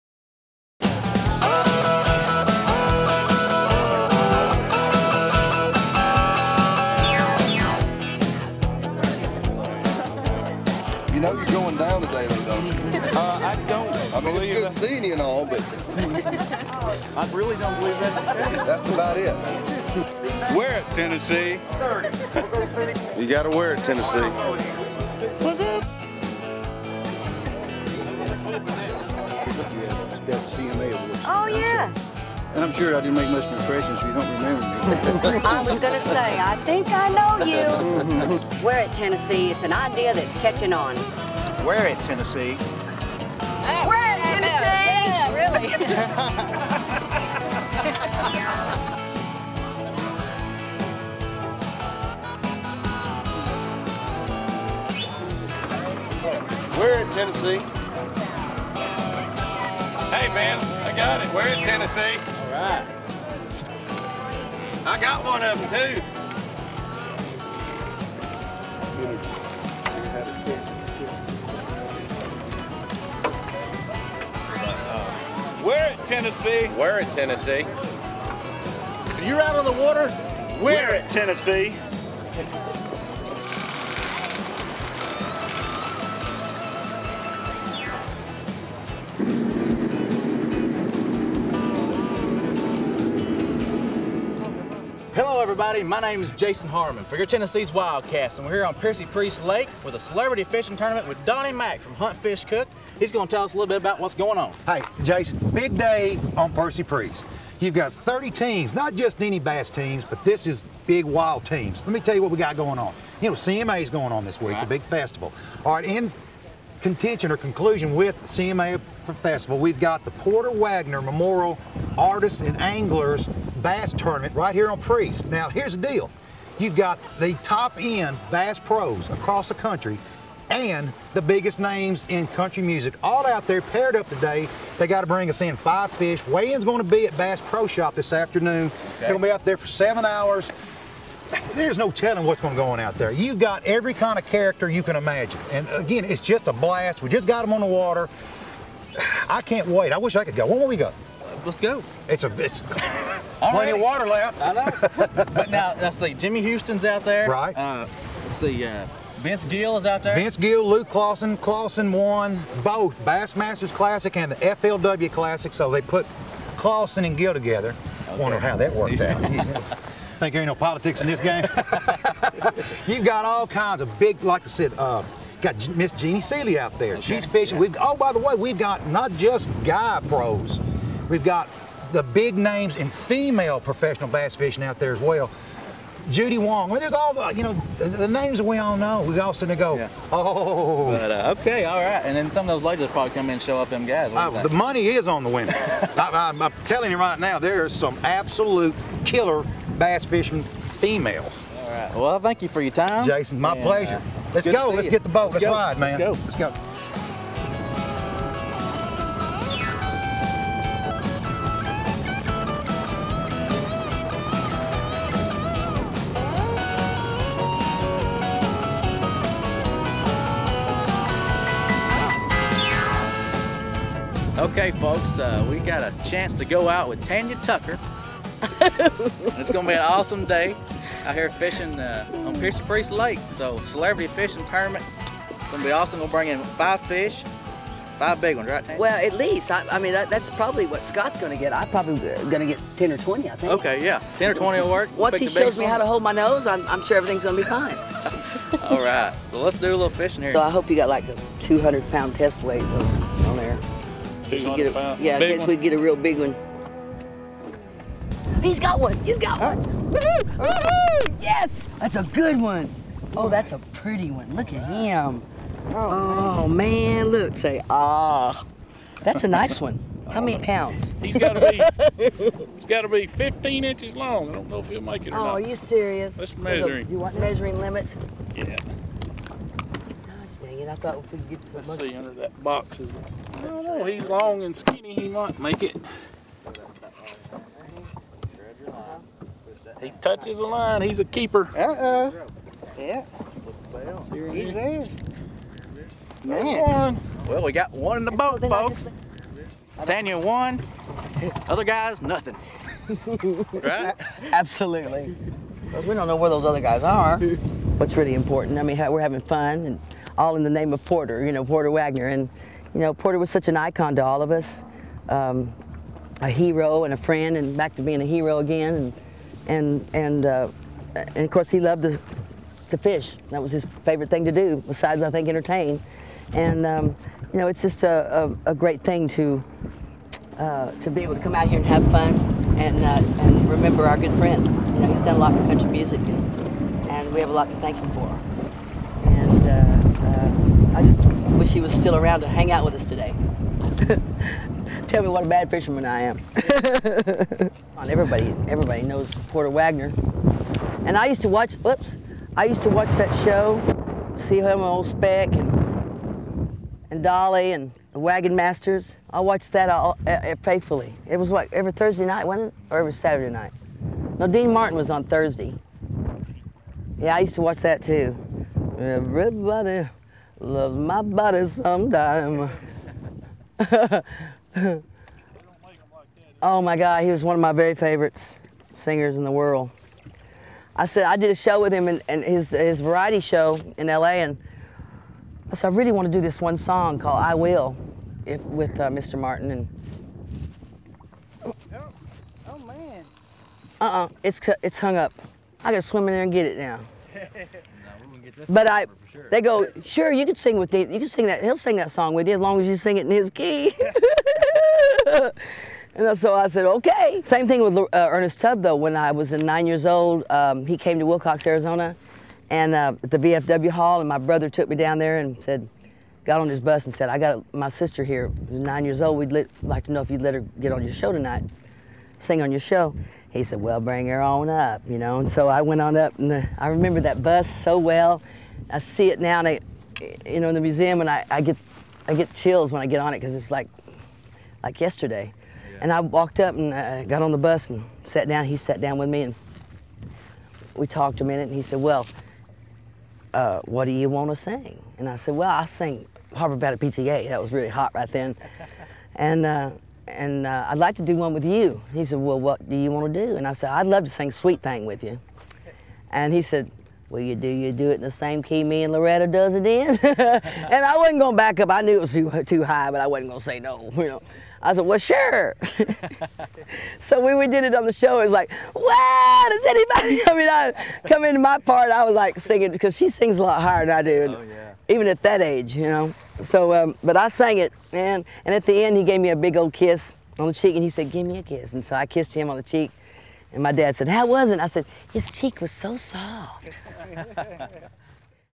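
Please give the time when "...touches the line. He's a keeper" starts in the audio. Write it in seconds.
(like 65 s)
289 s.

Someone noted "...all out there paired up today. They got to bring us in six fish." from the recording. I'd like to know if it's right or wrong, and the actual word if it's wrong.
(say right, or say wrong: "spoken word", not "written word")
wrong: "five", not "six".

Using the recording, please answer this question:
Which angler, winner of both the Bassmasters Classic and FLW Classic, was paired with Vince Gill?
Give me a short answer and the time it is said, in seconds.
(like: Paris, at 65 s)
Luke Clausen, at 160 s.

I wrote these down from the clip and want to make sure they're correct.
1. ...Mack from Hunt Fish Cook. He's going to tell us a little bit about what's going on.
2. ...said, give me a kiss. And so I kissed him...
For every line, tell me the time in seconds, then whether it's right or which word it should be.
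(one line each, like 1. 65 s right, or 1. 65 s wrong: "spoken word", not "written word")
1. 101 s right
2. 480 s right.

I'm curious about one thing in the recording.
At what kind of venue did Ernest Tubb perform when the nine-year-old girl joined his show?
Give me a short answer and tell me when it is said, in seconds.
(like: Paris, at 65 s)
VFW Hall, at 413 s.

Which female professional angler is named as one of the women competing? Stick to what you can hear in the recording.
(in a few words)
Judy Wong.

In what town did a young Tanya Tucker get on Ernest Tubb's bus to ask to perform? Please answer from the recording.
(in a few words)
Willcox, Arizona.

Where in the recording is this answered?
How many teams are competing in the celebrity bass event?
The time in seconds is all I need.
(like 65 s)
107 s.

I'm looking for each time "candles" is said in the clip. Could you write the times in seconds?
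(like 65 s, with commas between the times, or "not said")
not said.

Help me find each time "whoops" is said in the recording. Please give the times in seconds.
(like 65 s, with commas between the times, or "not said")
351 s.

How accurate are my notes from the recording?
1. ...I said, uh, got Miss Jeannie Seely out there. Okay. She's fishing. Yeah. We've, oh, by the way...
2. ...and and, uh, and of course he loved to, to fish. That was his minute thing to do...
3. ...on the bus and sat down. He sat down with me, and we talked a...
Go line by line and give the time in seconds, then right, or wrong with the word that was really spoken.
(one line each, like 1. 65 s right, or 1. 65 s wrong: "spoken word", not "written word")
1. 174 s right
2. 319 s wrong: "favorite", not "minute"
3. 437 s right.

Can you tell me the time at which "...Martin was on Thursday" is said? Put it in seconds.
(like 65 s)
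364 s.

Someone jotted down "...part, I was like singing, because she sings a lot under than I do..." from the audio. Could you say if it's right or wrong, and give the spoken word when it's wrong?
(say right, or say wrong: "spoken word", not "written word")
wrong: "higher", not "under".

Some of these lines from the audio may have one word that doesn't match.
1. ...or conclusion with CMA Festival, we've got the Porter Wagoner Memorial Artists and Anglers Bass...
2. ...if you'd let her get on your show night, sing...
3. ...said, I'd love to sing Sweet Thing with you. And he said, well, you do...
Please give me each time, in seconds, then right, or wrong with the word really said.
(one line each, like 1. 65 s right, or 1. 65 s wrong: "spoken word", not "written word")
1. 117 s right
2. 420 s wrong: "tonight", not "night"
3. 453 s right.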